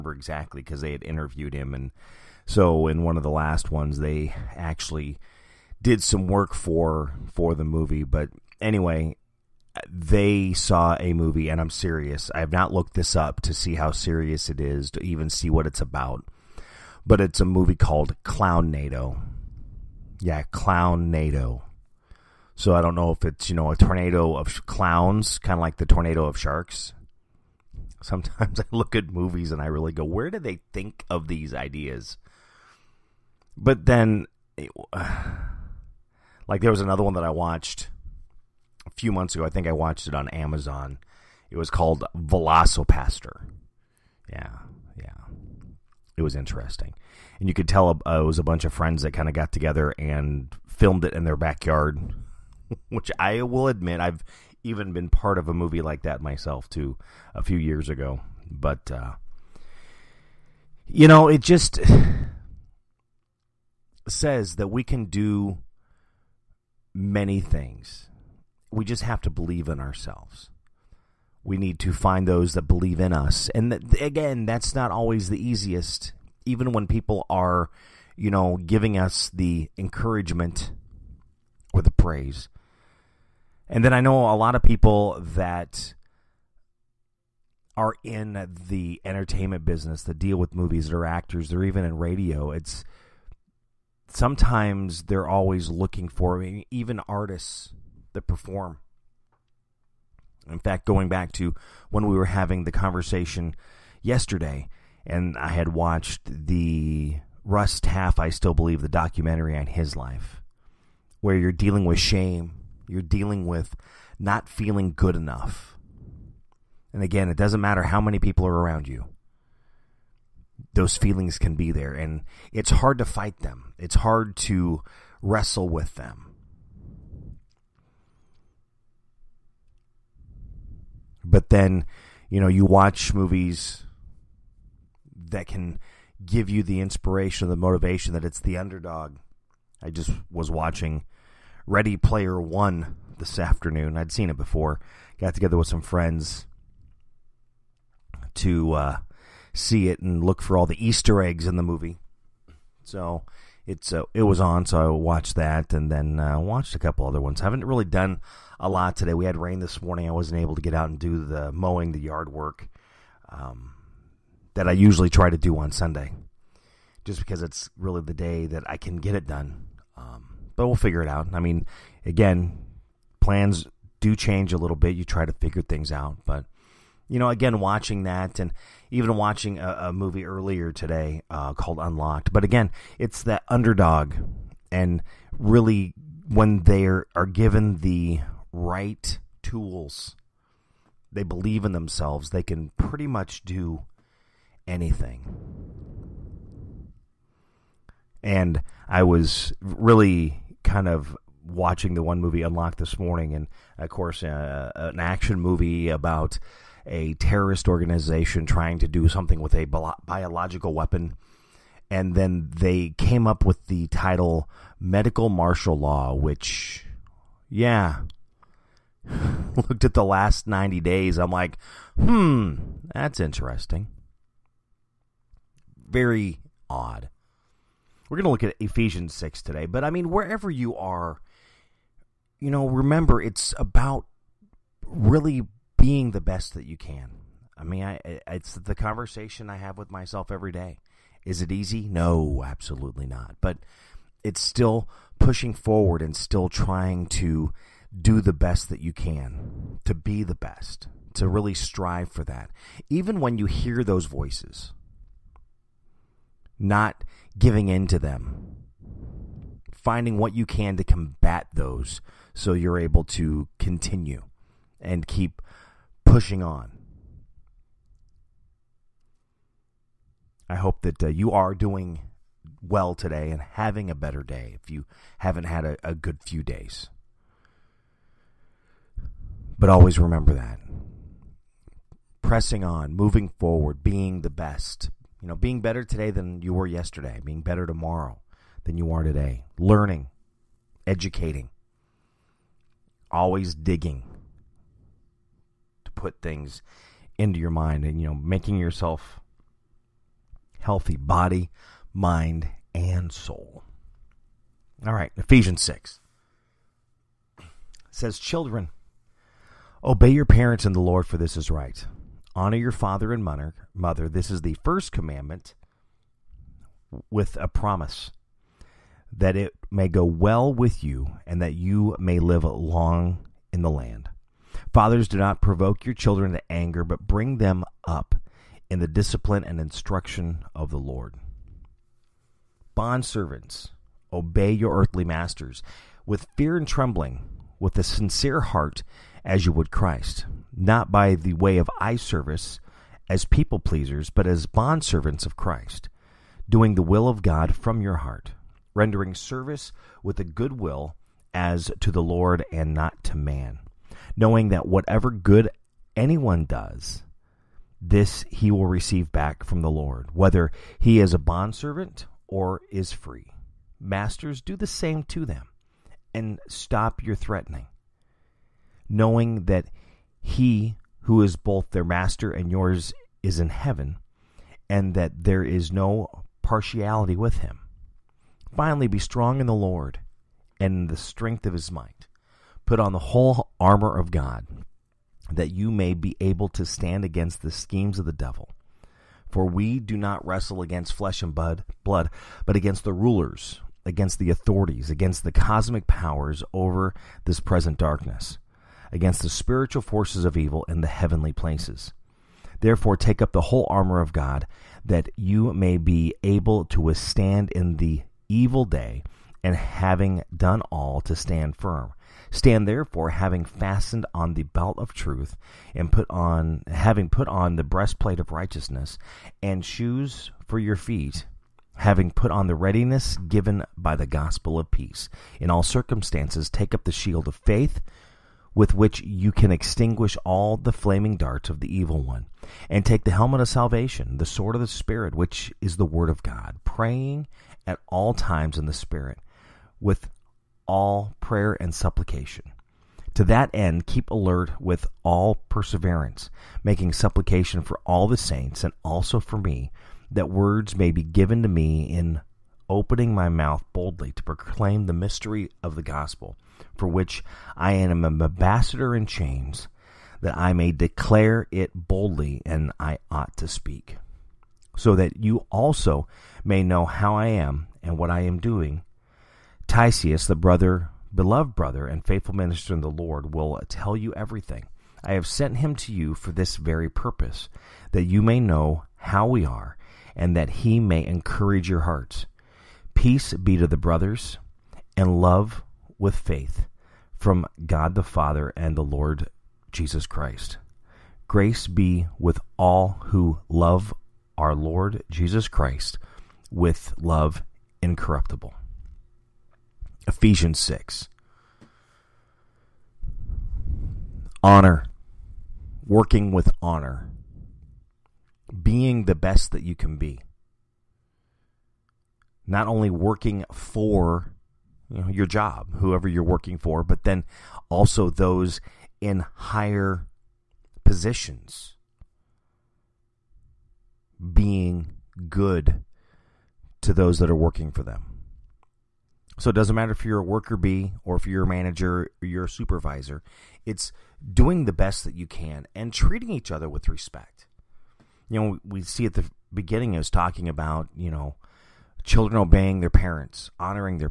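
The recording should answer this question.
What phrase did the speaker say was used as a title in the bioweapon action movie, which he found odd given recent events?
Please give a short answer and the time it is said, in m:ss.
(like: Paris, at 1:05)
Medical Martial Law, at 3:34.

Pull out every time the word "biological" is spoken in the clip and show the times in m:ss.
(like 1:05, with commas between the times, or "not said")
3:29.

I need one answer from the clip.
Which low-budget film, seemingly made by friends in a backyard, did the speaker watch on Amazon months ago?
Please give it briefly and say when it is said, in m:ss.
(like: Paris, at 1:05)
Velocipastor, at 0:42.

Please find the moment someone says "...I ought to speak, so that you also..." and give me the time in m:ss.
7:42.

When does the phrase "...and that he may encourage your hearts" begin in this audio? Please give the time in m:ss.
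8:00.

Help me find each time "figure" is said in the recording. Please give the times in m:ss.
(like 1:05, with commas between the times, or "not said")
2:50, 2:55.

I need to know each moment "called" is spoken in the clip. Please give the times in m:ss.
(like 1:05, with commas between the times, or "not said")
0:17, 0:41, 3:01.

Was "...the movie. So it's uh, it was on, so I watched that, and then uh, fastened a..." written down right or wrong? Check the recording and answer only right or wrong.
wrong.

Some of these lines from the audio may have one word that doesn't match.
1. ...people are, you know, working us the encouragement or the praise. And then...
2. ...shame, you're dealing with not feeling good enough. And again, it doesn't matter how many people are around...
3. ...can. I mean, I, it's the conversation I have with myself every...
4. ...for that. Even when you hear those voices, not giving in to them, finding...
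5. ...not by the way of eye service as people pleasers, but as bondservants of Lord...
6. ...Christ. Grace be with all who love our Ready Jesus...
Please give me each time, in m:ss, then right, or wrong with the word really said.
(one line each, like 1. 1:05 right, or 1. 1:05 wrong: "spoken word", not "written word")
1. 1:16 wrong: "giving", not "working"
2. 1:51 right
3. 3:56 right
4. 4:12 right
5. 5:40 wrong: "Christ", not "Lord"
6. 8:10 wrong: "Lord", not "Ready".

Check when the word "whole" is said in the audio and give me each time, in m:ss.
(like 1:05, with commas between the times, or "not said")
6:22, 6:43.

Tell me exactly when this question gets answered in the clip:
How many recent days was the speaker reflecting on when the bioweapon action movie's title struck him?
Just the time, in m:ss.
3:40.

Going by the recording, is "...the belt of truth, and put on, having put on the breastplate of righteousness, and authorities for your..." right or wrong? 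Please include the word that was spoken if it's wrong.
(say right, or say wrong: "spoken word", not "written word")
wrong: "shoes", not "authorities".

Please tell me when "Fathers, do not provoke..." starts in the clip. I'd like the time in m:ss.
5:24.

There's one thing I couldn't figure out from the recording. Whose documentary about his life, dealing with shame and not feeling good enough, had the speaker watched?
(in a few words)
Russ Taff.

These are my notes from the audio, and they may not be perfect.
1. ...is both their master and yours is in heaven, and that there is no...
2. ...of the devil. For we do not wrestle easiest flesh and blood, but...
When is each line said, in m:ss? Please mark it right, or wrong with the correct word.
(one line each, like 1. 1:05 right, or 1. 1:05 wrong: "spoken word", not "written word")
1. 6:11 right
2. 6:27 wrong: "against", not "easiest".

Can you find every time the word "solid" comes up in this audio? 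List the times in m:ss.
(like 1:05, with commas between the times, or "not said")
not said.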